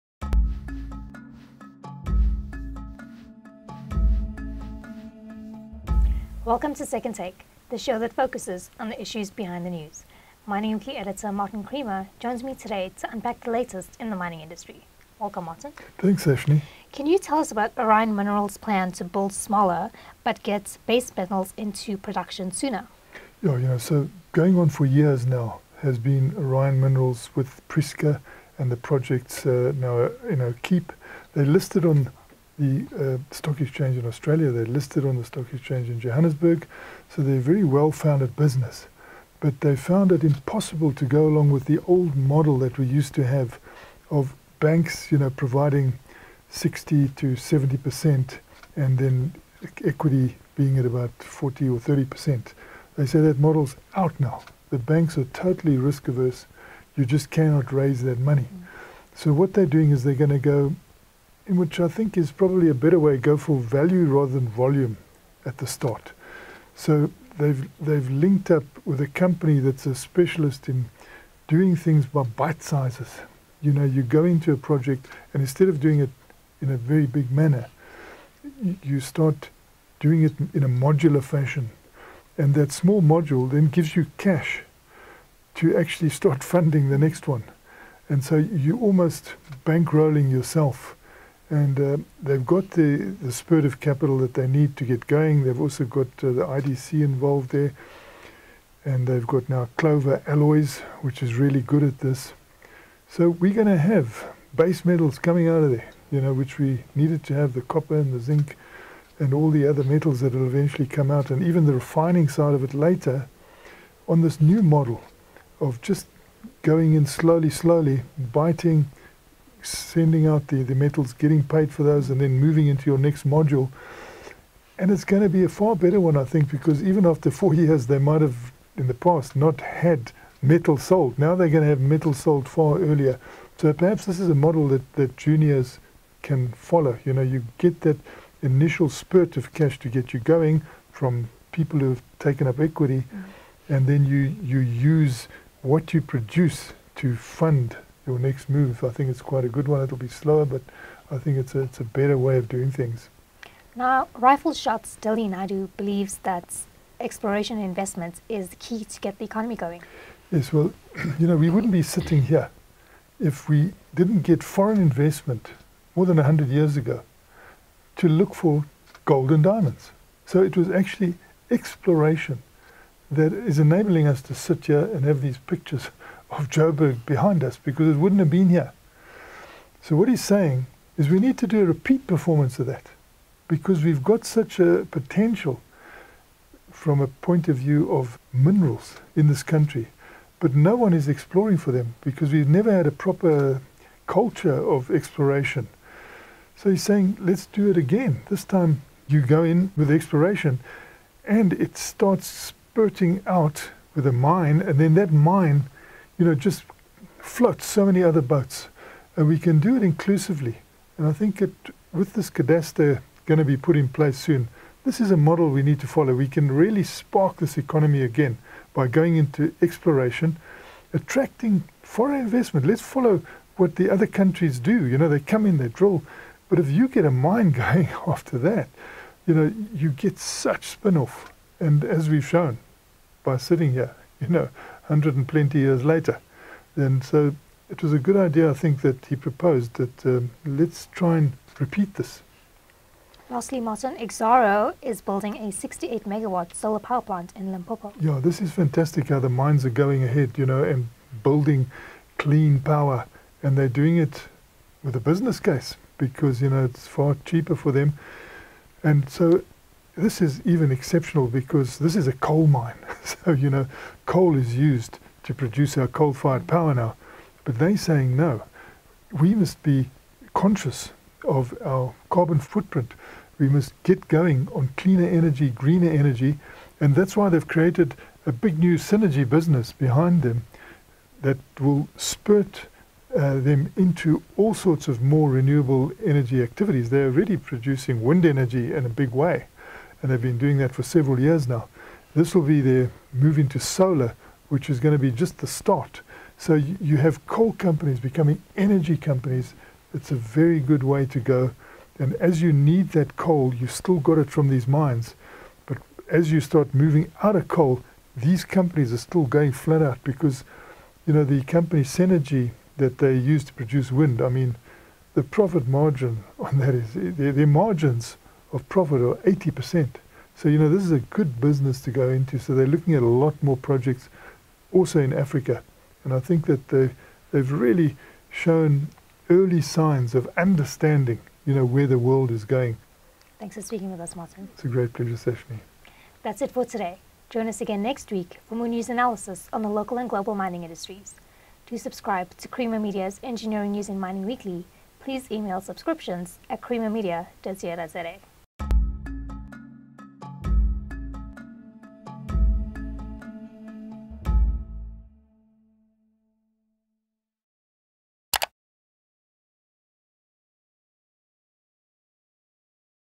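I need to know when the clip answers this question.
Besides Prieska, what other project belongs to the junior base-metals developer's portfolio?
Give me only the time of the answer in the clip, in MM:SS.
00:30.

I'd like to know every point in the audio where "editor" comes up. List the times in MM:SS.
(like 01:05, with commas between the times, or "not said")
00:10.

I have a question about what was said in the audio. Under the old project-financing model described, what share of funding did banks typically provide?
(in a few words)
60 to 70 percent.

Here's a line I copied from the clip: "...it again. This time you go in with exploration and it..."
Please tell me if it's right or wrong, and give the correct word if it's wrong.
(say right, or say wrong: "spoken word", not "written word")
right.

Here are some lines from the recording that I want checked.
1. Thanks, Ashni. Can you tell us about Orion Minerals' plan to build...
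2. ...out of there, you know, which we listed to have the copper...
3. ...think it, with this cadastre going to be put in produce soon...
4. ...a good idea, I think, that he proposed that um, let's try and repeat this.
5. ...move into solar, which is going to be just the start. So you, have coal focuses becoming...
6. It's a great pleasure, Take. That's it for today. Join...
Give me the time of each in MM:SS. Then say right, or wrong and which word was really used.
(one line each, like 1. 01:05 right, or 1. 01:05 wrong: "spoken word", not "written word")
1. 00:15 right
2. 01:45 wrong: "needed", not "listed"
3. 03:31 wrong: "place", not "produce"
4. 03:57 right
5. 04:53 wrong: "companies", not "focuses"
6. 05:34 wrong: "Sashmi", not "Take".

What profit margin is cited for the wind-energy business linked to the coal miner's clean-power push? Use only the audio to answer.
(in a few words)
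80%.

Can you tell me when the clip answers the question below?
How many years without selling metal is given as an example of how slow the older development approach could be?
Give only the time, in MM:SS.
02:07.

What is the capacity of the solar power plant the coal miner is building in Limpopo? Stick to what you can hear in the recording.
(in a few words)
68 megawatts.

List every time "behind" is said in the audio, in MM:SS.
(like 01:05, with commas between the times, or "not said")
00:09, 02:57, 04:39.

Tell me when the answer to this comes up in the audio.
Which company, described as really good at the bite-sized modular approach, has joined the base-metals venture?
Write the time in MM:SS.
01:39.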